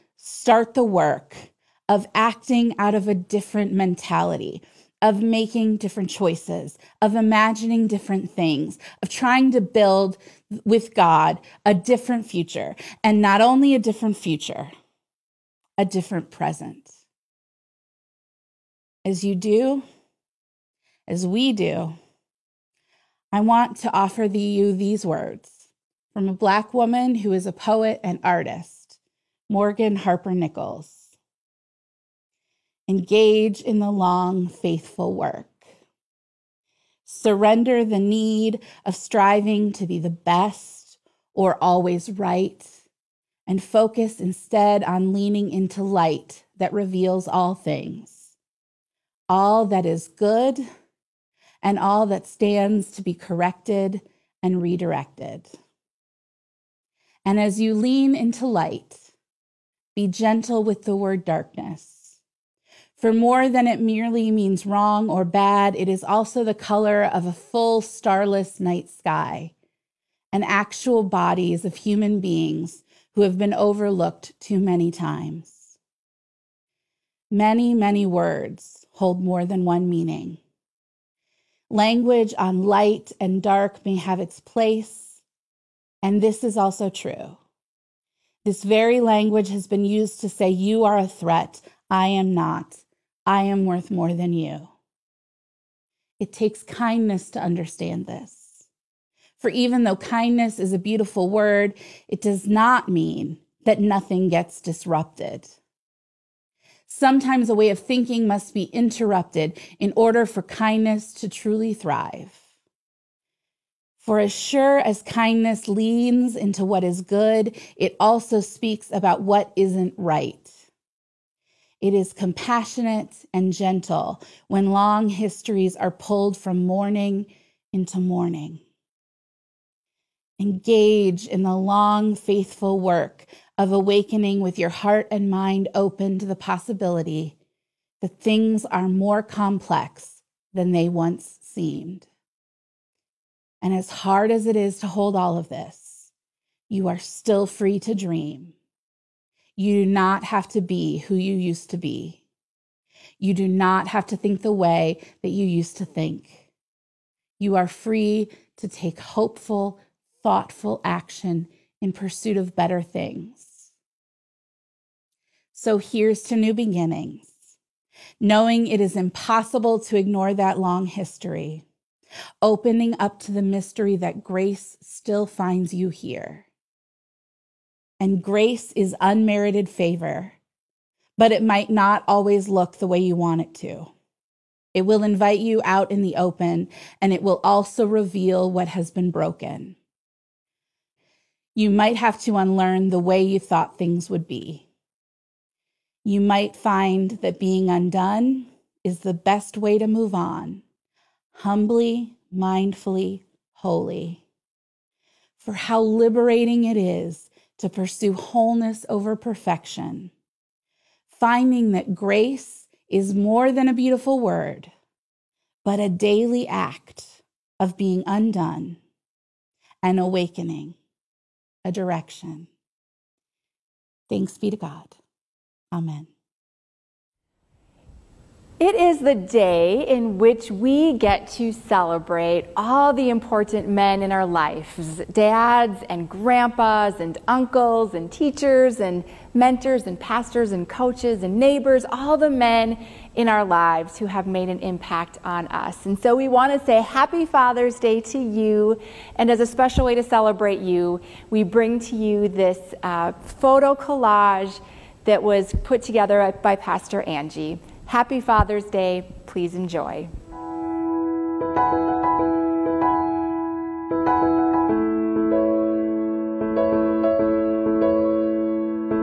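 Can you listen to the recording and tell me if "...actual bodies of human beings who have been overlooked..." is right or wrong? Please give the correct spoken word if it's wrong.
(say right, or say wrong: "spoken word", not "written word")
right.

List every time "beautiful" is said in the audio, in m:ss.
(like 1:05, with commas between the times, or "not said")
1:40, 3:33.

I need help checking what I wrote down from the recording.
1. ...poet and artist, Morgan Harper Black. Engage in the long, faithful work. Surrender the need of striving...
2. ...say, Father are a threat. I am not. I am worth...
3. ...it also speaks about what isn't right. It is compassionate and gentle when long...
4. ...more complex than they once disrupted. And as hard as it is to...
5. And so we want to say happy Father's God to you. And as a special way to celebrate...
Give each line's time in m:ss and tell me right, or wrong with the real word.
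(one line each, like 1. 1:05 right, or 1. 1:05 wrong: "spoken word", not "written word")
1. 0:27 wrong: "Nichols", not "Black"
2. 1:30 wrong: "You", not "Father"
3. 1:57 right
4. 2:18 wrong: "seemed", not "disrupted"
5. 4:05 wrong: "Day", not "God".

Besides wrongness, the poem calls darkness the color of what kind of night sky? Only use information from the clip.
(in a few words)
full starless.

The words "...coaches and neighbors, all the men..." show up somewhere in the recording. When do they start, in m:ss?
4:00.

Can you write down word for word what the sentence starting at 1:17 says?
Many, many words hold more than one meaning.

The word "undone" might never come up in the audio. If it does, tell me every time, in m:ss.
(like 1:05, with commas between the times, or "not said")
3:17, 3:38.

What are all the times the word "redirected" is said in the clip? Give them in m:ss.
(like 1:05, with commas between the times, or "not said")
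0:54.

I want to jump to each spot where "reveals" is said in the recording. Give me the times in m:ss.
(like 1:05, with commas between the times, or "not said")
0:46, 3:07.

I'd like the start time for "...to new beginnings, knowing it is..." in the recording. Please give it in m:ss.
2:46.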